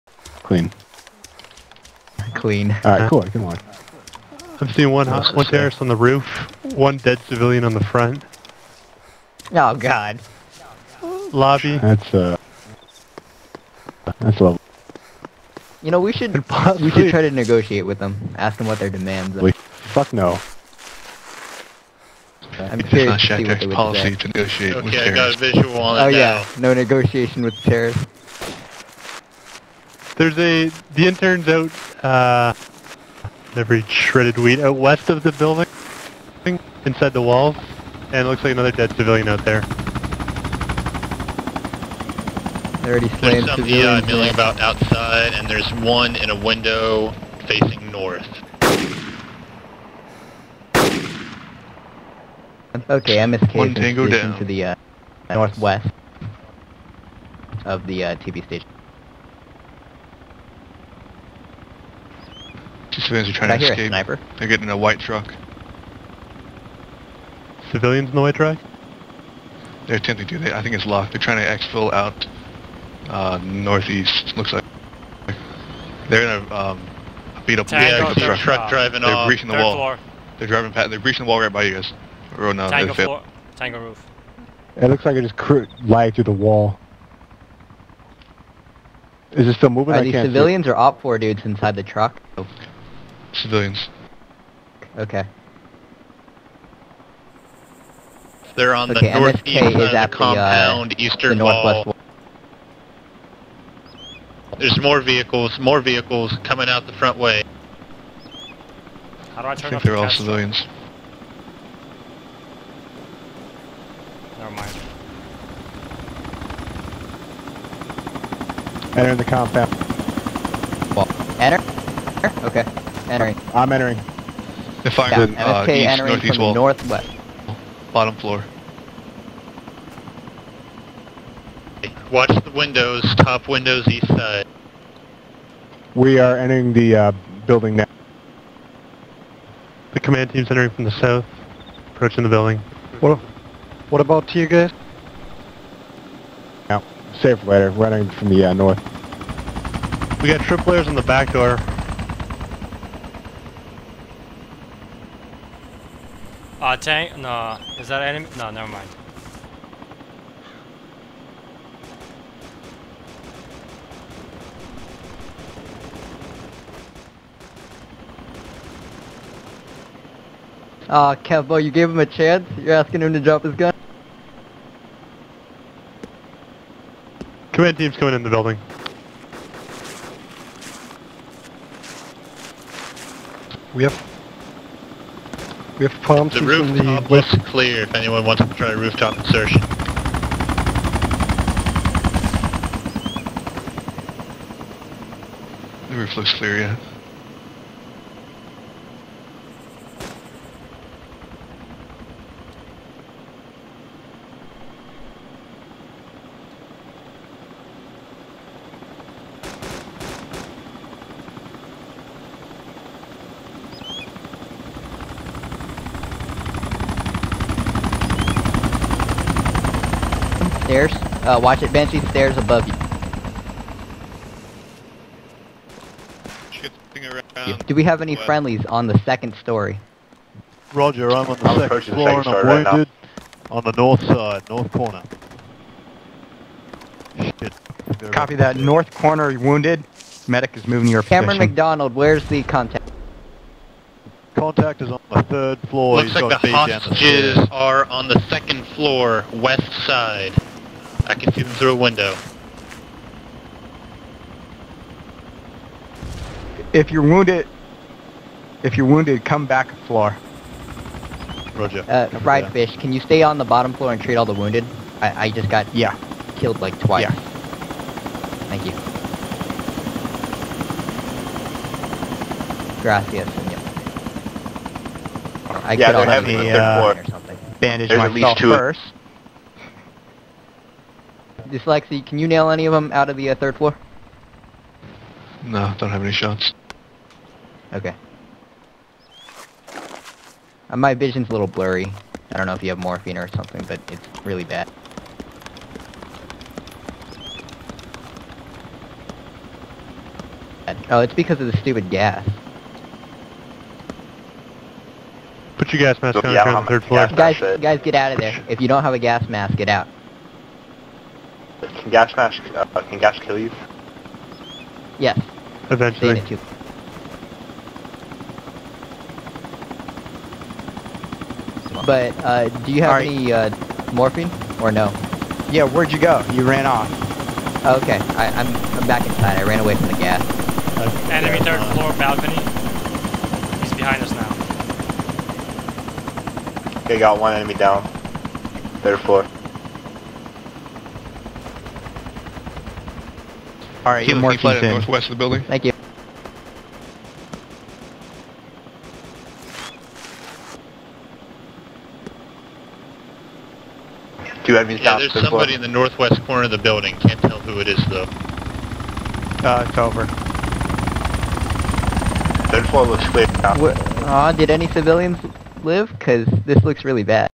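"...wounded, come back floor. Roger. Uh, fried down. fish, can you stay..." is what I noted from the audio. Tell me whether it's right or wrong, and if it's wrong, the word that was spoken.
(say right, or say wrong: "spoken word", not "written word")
right.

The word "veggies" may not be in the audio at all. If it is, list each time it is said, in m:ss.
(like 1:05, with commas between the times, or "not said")
not said.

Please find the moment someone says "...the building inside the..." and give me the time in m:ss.
0:35.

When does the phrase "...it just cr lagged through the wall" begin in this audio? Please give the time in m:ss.
1:25.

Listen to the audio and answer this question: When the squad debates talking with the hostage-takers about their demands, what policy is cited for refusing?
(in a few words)
No negotiation with terrorists.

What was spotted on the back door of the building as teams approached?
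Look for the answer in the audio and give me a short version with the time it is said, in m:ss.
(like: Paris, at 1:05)
Trip layers, at 2:30.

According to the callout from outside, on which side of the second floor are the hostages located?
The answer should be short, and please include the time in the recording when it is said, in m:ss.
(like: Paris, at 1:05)
West side, at 4:09.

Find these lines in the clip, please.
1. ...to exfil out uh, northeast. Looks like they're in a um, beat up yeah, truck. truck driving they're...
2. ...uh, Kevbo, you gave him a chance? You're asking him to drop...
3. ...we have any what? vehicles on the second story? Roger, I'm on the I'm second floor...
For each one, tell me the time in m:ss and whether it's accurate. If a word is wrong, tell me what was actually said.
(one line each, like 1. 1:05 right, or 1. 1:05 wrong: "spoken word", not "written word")
1. 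1:11 right
2. 2:51 right
3. 3:47 wrong: "friendlies", not "vehicles".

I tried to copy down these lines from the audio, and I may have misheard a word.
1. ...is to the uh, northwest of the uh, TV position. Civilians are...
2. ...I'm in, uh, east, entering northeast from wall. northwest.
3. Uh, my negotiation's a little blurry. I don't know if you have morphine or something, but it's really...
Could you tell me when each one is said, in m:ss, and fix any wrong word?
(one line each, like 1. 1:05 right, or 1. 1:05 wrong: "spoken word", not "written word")
1. 0:53 wrong: "station", not "position"
2. 2:04 right
3. 4:50 wrong: "vision", not "negotiation".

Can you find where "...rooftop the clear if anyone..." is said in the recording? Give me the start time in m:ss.
3:06.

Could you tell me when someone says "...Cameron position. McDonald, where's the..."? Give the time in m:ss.
4:01.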